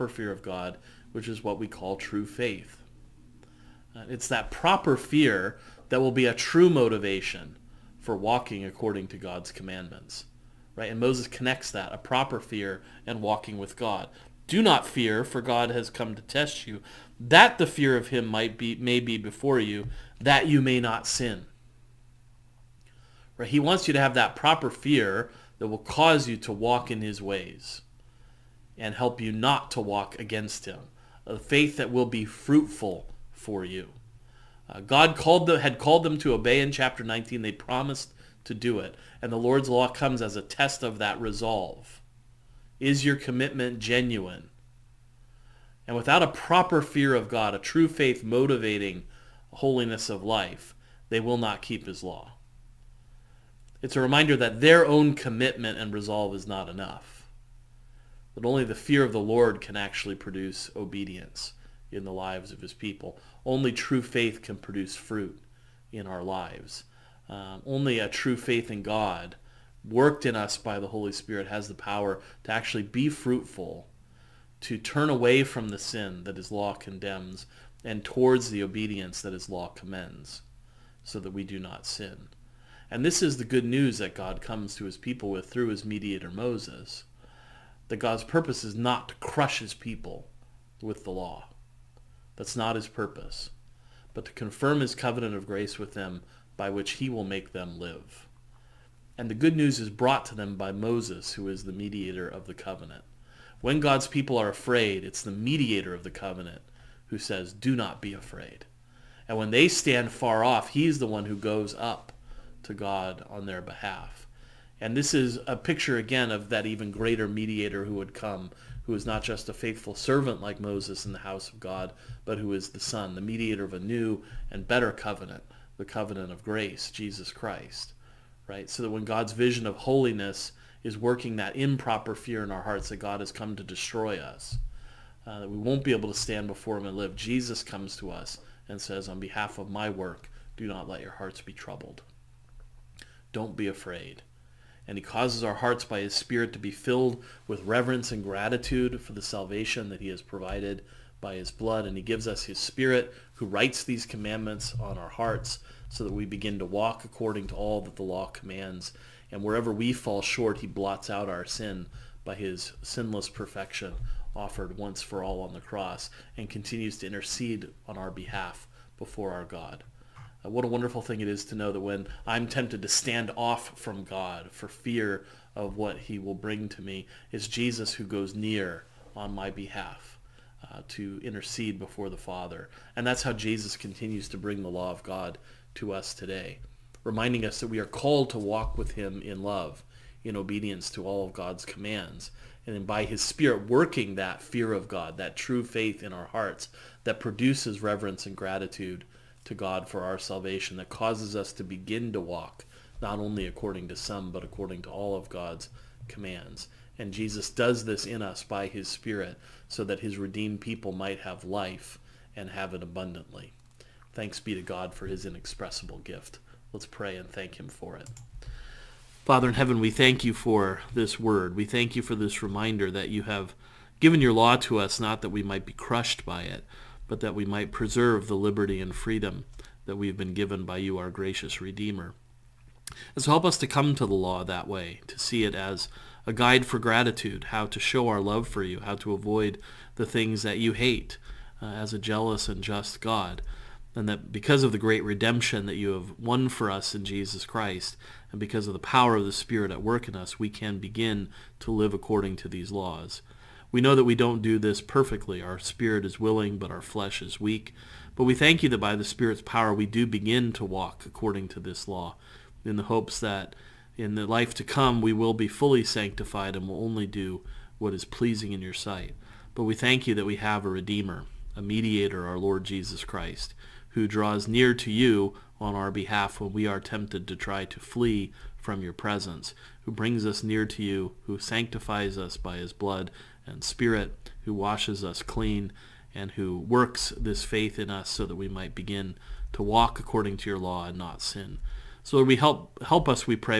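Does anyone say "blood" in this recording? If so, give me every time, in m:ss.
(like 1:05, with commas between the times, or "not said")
2:31, 4:42.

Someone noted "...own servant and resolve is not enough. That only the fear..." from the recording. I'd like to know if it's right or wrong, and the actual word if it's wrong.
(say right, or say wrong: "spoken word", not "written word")
wrong: "commitment", not "servant".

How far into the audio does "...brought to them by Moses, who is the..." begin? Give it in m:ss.
1:39.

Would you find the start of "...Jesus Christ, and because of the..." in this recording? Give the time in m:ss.
4:07.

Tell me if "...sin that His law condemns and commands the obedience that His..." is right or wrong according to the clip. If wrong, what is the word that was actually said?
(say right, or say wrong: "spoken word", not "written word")
wrong: "towards", not "commands".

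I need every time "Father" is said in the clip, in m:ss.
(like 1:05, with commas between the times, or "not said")
3:02, 3:39.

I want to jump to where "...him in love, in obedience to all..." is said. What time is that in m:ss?
3:08.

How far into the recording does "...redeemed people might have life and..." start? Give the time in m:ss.
3:30.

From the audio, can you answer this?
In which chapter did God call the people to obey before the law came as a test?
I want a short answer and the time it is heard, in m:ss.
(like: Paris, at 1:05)
Chapter 19, at 0:36.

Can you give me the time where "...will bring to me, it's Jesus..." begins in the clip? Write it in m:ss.
2:56.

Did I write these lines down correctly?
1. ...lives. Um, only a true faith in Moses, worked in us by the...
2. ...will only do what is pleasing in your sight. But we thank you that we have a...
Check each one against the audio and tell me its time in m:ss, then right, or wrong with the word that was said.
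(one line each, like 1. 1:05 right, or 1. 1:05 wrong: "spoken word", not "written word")
1. 1:06 wrong: "God", not "Moses"
2. 4:26 right.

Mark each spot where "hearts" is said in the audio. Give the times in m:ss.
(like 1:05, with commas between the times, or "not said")
2:12, 2:21, 2:25, 2:35, 3:16.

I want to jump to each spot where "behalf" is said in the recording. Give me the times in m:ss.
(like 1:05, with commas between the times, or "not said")
1:53, 2:19, 2:48, 2:59, 4:35.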